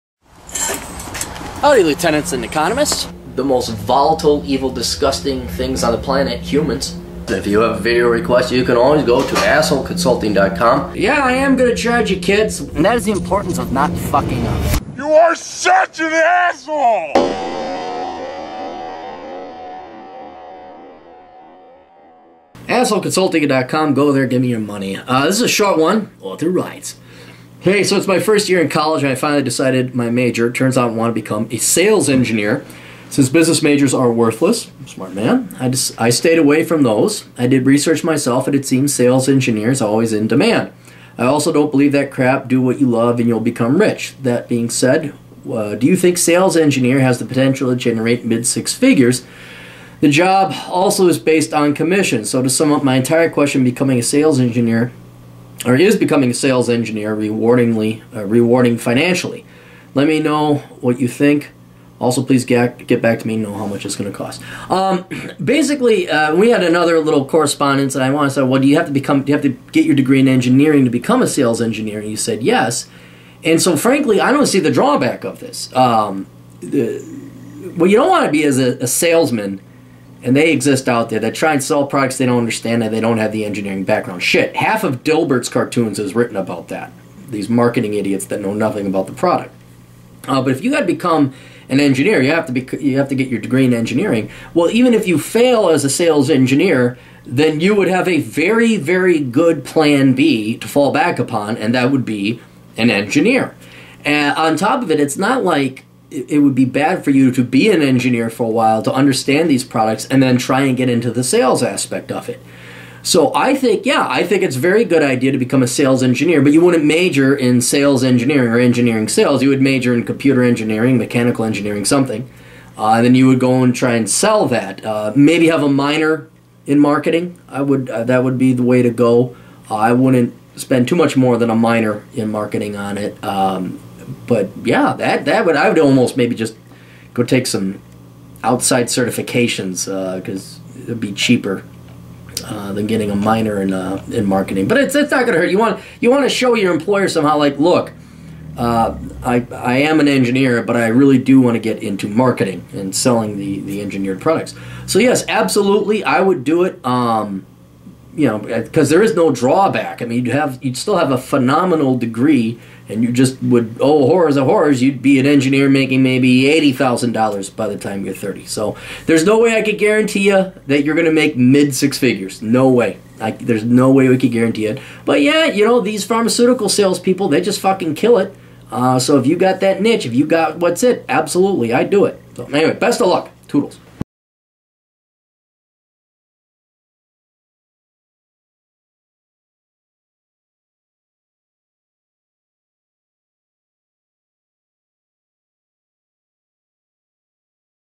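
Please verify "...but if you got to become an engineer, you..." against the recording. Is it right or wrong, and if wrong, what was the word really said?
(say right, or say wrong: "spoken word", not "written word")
right.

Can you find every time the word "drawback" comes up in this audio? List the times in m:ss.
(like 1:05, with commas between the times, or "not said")
1:14, 2:39.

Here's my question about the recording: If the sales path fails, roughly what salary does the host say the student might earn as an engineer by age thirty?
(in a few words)
$80,000.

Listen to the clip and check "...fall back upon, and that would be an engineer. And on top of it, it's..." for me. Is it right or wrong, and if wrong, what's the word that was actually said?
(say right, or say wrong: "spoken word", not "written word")
right.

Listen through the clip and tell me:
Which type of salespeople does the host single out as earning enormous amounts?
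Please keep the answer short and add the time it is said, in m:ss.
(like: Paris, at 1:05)
Pharmaceutical salespeople, at 2:56.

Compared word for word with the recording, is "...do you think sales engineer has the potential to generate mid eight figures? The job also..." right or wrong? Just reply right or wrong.
wrong.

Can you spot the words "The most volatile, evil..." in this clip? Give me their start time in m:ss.
0:03.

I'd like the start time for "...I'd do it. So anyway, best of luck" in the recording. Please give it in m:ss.
3:01.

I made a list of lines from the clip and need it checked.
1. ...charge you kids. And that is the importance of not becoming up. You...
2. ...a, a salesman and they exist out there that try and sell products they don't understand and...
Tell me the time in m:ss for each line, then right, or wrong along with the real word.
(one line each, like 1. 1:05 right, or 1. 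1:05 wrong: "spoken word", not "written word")
1. 0:11 wrong: "fucking", not "becoming"
2. 1:18 right.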